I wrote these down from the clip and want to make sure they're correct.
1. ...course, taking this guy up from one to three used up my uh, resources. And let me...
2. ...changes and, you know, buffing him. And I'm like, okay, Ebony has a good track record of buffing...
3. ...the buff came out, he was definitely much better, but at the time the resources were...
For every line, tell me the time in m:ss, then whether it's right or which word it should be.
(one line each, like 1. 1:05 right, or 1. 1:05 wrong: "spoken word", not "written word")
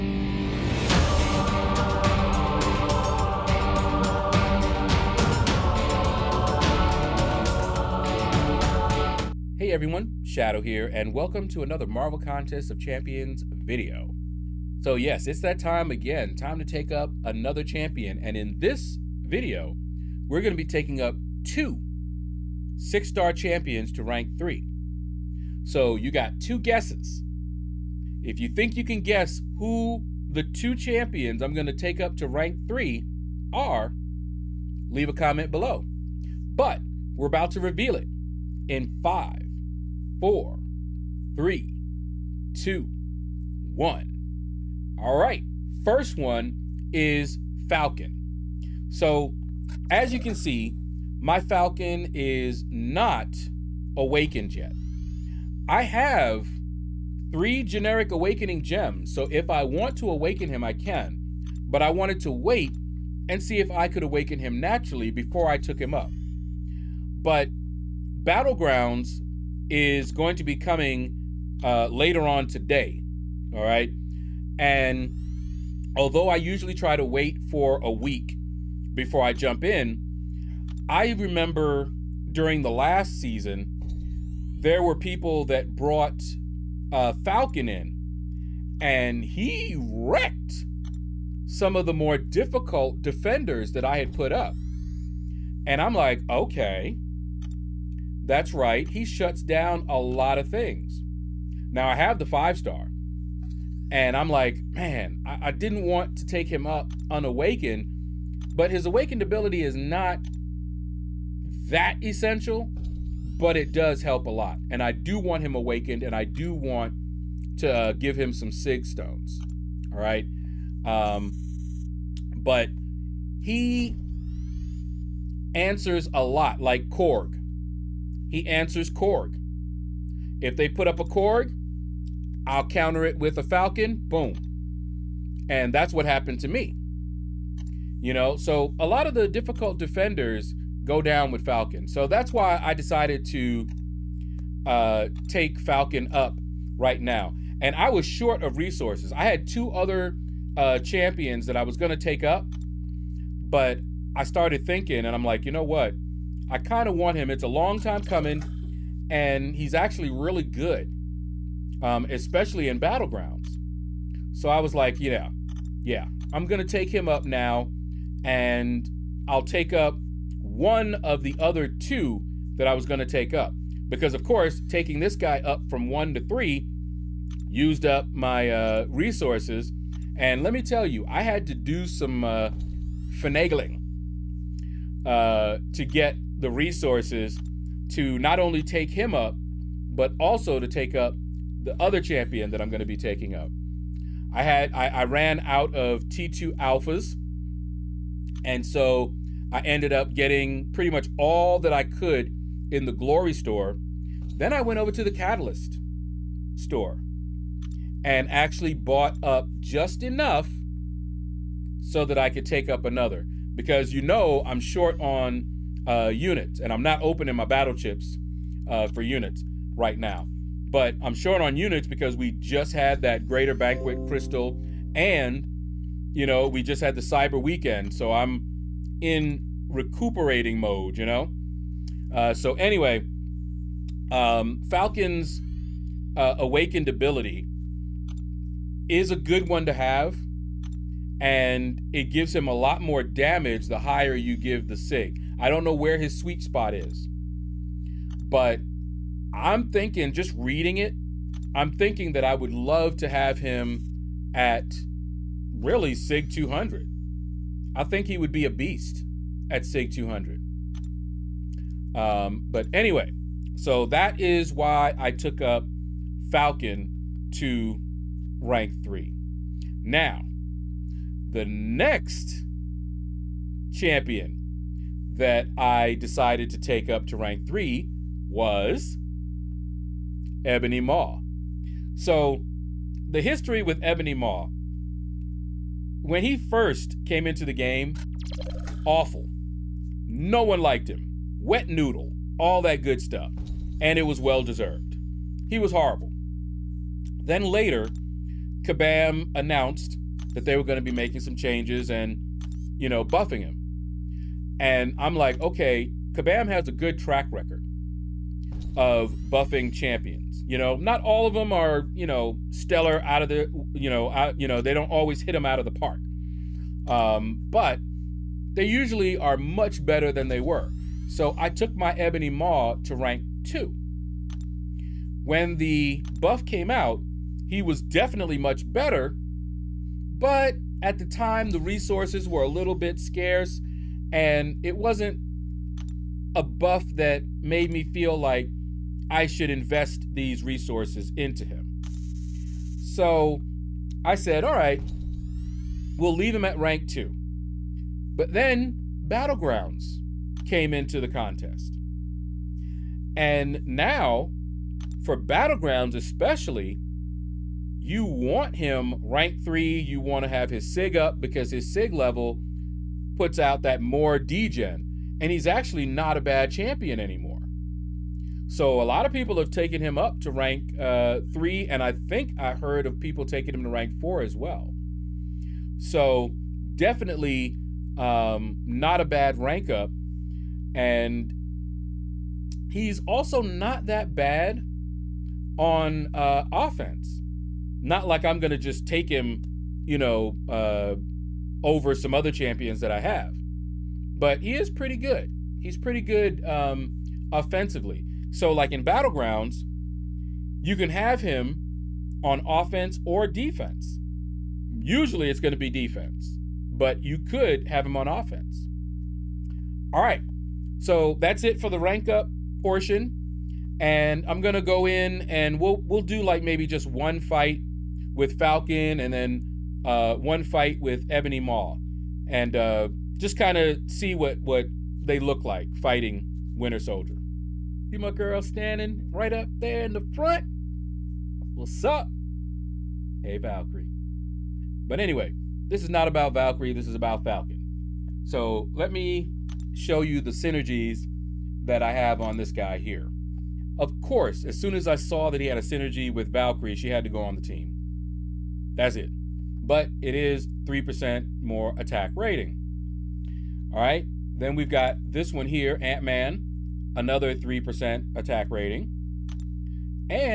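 1. 2:54 right
2. 5:01 wrong: "Kabam", not "Ebony"
3. 5:25 right.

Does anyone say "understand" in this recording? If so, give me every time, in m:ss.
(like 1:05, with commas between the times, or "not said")
not said.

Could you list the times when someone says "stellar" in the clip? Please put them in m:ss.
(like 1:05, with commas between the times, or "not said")
5:12.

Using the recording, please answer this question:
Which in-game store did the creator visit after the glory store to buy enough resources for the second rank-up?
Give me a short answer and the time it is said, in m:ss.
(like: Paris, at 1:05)
catalyst store, at 3:25.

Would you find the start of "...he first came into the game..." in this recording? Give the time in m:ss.
4:46.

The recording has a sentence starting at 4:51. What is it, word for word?
Wet noodle, all that good stuff.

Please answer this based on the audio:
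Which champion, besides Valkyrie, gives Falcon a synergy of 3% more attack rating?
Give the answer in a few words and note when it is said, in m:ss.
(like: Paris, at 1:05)
Ant-Man, at 7:35.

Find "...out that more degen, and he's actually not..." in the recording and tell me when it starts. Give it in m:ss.
6:03.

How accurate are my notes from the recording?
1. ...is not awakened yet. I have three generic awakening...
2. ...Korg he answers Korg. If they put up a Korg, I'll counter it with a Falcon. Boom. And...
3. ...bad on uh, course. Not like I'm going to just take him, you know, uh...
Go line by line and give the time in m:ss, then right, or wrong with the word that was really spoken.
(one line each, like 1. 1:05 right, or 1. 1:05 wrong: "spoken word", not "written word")
1. 0:52 right
2. 2:06 right
3. 6:24 wrong: "offense", not "course".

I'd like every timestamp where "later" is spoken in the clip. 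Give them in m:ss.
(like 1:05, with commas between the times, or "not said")
1:11, 4:57.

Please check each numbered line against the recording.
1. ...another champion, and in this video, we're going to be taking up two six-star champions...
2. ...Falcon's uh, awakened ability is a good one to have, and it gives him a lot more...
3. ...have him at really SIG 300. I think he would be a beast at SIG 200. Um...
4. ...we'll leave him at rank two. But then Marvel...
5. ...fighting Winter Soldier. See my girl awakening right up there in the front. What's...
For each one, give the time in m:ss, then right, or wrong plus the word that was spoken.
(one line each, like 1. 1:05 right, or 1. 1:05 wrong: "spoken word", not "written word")
1. 0:17 right
2. 3:54 right
3. 4:13 wrong: "200", not "300"
4. 5:45 wrong: "Battlegrounds", not "Marvel"
5. 7:05 wrong: "standing", not "awakening".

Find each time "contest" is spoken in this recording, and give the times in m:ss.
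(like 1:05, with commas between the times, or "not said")
0:12, 5:51.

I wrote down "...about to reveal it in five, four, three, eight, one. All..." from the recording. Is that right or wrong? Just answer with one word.
wrong.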